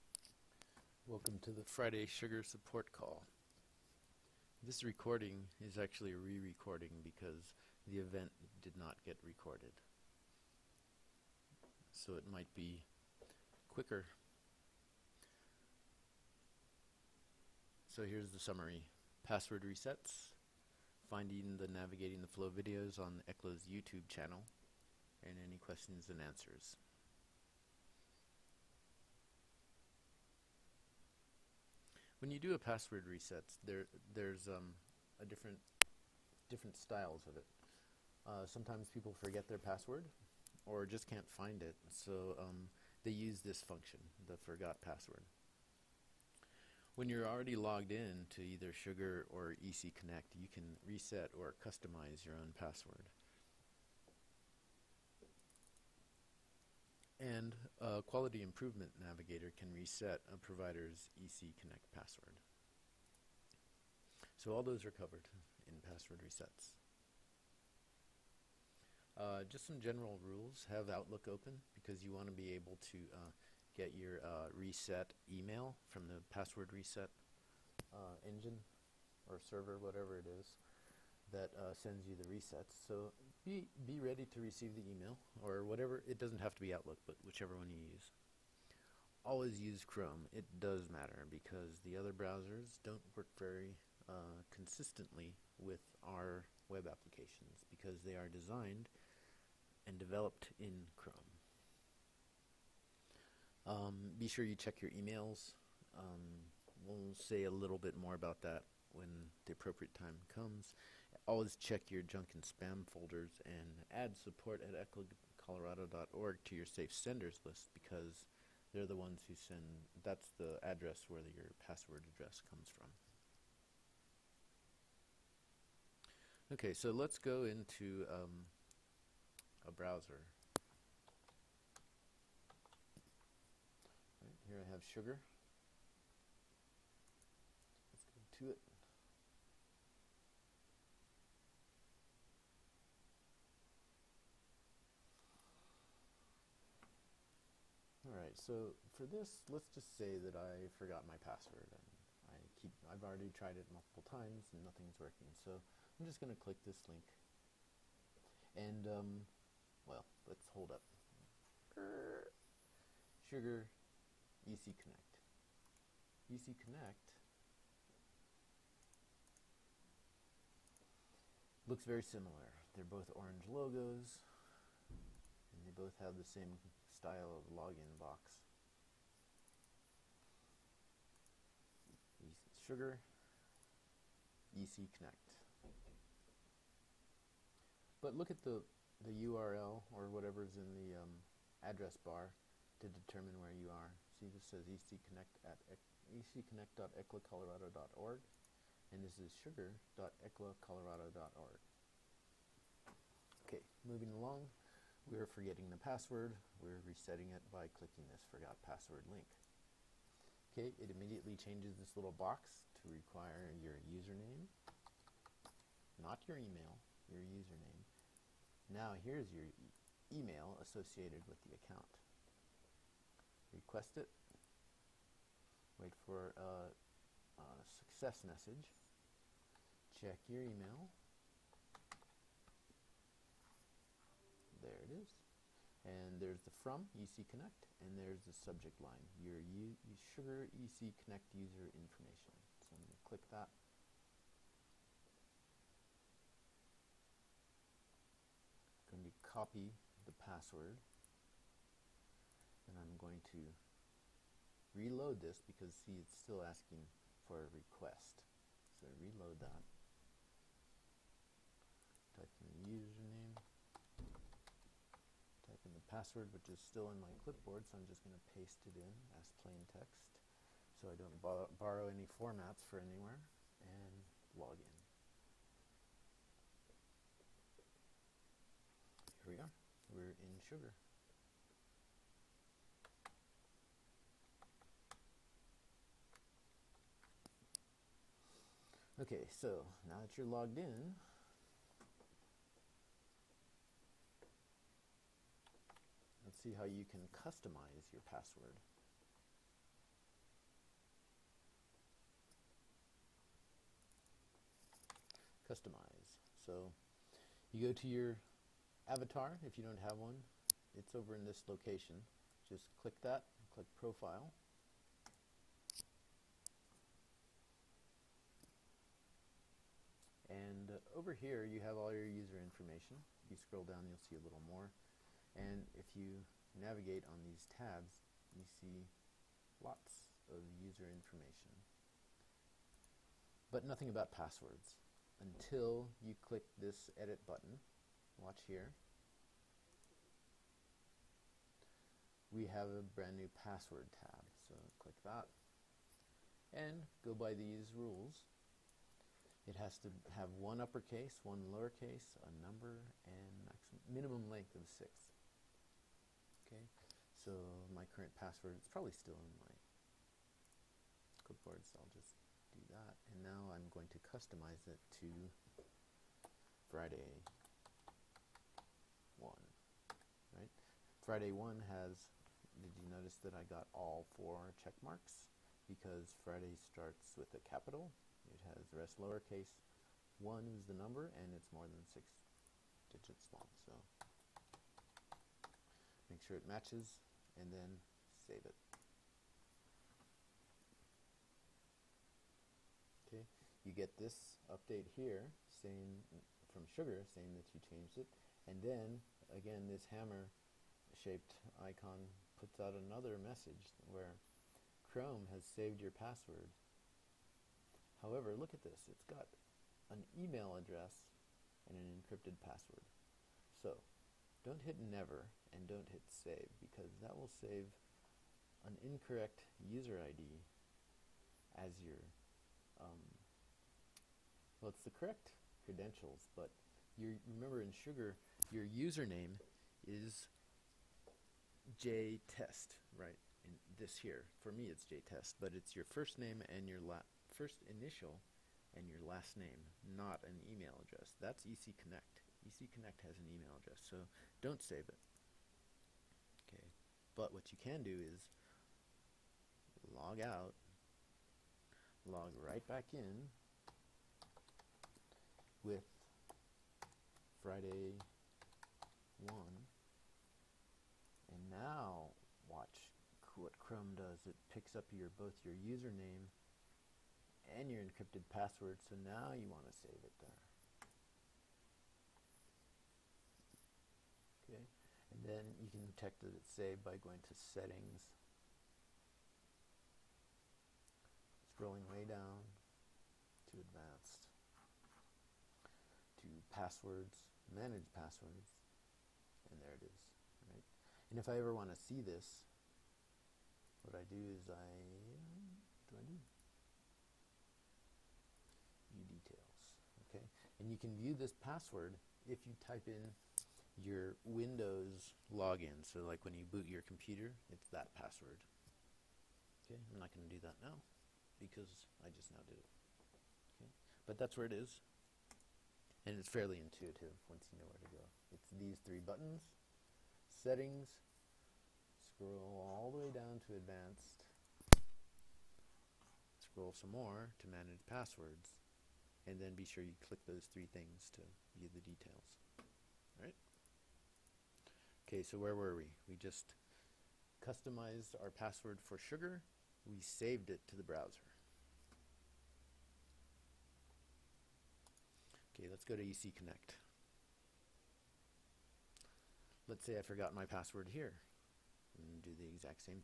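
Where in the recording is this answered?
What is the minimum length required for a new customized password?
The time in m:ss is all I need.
5:54.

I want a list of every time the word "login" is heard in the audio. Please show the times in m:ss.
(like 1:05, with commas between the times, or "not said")
2:57, 8:25.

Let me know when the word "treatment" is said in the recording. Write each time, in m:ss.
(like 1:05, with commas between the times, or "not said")
not said.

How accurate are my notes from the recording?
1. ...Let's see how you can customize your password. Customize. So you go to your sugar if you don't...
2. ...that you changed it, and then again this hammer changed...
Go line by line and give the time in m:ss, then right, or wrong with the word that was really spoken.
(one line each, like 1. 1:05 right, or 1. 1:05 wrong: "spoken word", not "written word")
1. 4:56 wrong: "avatar", not "sugar"
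2. 6:37 wrong: "shaped", not "changed".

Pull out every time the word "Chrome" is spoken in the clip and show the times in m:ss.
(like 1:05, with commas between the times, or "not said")
1:29, 1:40, 6:44, 7:43.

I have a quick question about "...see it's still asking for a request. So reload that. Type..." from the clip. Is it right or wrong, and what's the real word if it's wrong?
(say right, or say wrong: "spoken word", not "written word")
right.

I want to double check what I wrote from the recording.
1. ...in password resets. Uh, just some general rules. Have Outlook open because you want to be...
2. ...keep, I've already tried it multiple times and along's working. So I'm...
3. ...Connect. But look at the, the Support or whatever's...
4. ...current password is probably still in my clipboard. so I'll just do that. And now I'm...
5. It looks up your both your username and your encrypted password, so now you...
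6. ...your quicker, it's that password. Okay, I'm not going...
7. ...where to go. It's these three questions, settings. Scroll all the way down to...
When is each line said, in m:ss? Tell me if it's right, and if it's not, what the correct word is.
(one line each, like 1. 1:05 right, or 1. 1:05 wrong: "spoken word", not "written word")
1. 1:05 right
2. 2:32 wrong: "nothing", not "along"
3. 3:04 wrong: "URL", not "Support"
4. 5:57 right
5. 7:44 wrong: "picks", not "looks"
6. 8:26 wrong: "computer", not "quicker"
7. 8:37 wrong: "buttons", not "questions".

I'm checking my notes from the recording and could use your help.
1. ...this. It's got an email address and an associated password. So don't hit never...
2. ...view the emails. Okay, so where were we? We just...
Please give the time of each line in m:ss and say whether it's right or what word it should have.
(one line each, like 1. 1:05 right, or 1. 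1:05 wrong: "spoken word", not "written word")
1. 6:48 wrong: "encrypted", not "associated"
2. 8:51 wrong: "details", not "emails".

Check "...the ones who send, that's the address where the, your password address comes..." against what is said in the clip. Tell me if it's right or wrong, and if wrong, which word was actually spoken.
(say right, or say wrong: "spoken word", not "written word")
right.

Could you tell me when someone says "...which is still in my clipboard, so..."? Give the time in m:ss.
4:26.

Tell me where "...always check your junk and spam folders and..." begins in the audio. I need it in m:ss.
1:51.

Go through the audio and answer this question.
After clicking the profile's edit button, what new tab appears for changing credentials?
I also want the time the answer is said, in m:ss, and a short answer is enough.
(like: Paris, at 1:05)
password tab, at 5:43.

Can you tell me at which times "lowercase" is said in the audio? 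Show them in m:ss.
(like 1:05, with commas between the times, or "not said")
5:51, 6:19.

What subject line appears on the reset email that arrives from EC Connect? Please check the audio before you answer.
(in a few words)
your U Sugar EC Connect user information.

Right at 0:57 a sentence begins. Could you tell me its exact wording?
And a quality improvement navigator can reset a provider's EC Connect password.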